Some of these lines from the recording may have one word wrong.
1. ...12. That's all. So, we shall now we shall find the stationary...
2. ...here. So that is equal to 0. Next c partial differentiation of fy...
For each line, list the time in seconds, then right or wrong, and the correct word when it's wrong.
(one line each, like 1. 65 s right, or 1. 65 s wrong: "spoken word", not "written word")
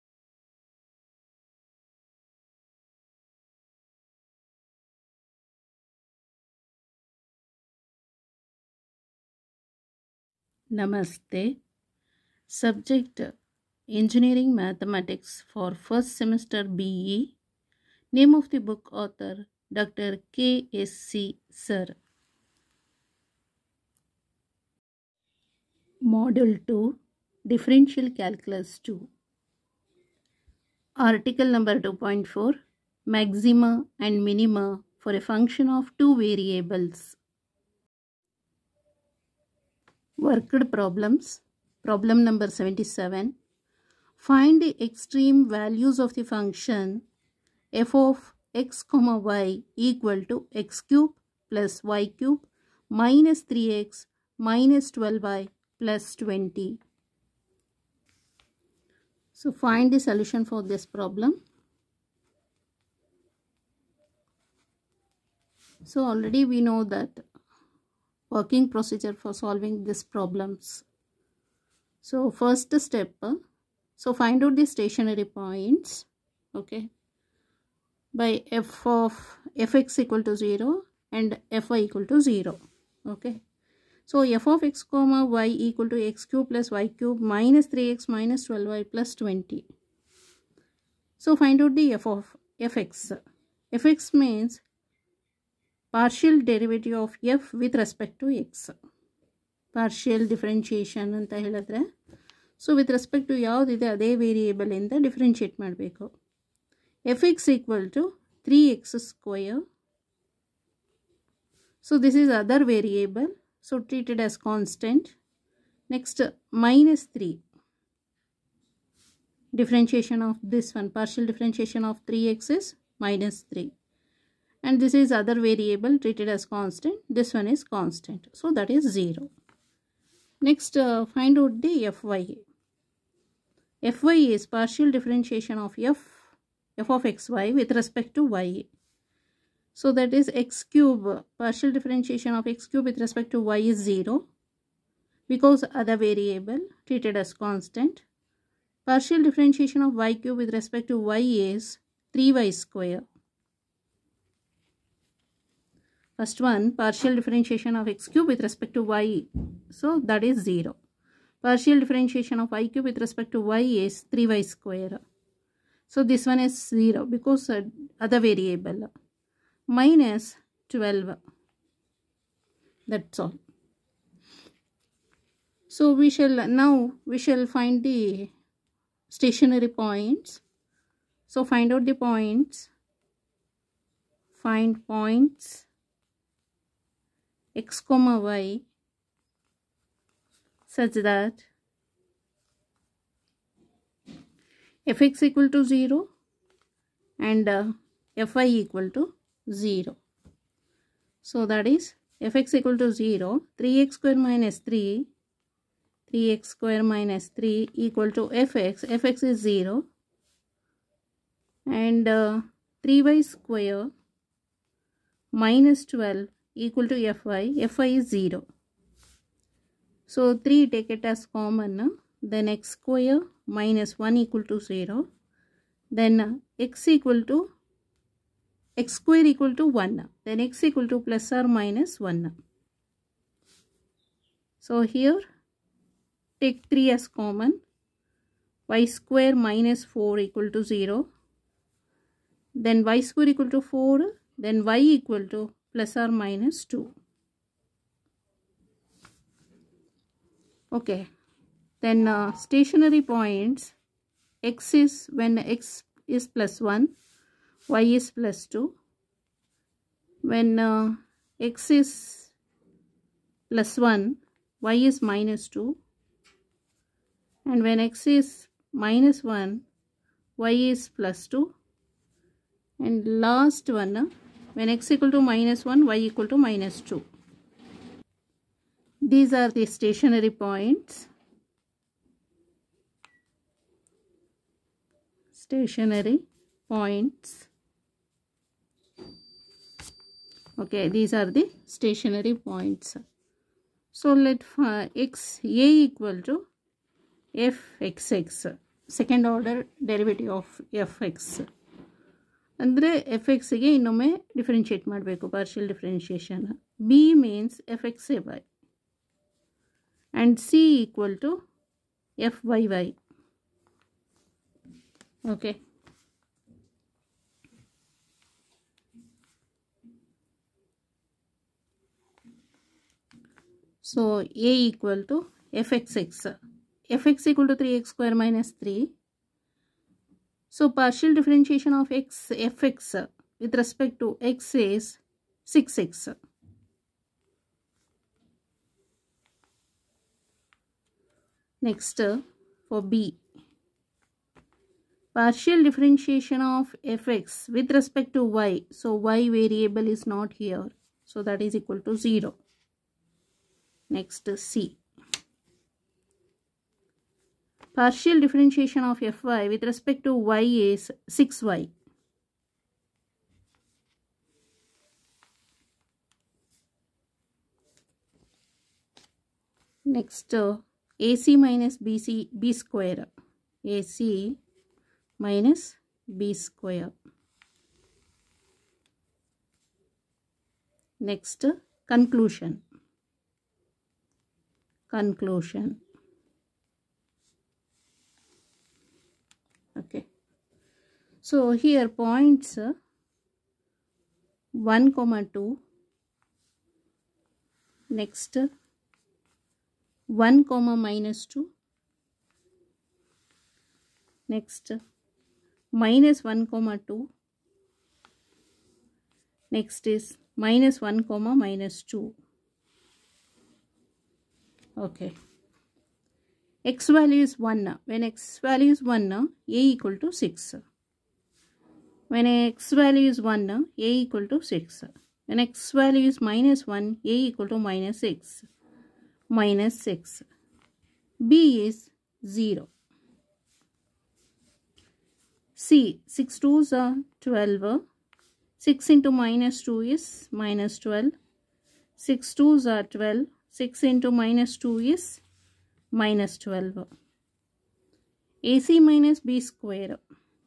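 1. 170 s right
2. 350 s right.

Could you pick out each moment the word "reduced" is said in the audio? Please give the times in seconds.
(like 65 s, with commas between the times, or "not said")
not said.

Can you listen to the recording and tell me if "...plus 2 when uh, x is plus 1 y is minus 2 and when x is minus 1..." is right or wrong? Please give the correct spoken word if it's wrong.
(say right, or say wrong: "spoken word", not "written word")
right.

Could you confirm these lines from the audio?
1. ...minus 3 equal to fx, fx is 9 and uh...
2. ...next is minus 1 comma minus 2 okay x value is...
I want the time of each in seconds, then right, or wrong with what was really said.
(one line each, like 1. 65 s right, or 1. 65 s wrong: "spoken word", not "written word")
1. 206 s wrong: "0", not "9"
2. 409 s right.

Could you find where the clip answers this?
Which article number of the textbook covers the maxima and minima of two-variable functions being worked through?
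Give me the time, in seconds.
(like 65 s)
31 s.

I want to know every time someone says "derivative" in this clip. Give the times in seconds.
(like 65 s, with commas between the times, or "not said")
96 s, 299 s.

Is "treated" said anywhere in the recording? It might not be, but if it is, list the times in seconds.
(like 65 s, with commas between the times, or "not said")
113 s, 126 s, 146 s.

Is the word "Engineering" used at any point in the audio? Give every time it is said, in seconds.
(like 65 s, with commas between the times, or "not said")
13 s.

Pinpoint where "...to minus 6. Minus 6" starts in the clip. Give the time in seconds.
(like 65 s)
427 s.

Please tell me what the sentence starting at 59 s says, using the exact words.
So find the solution for this problem.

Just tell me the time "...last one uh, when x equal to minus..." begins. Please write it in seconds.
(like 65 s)
273 s.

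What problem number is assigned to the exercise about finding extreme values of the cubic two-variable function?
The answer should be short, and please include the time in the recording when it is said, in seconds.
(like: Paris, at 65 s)
77, at 42 s.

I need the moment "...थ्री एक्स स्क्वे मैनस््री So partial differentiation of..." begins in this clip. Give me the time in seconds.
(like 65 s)
327 s.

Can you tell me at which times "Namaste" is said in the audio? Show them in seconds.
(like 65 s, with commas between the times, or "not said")
10 s.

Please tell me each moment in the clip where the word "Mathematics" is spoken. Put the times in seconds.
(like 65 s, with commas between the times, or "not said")
14 s.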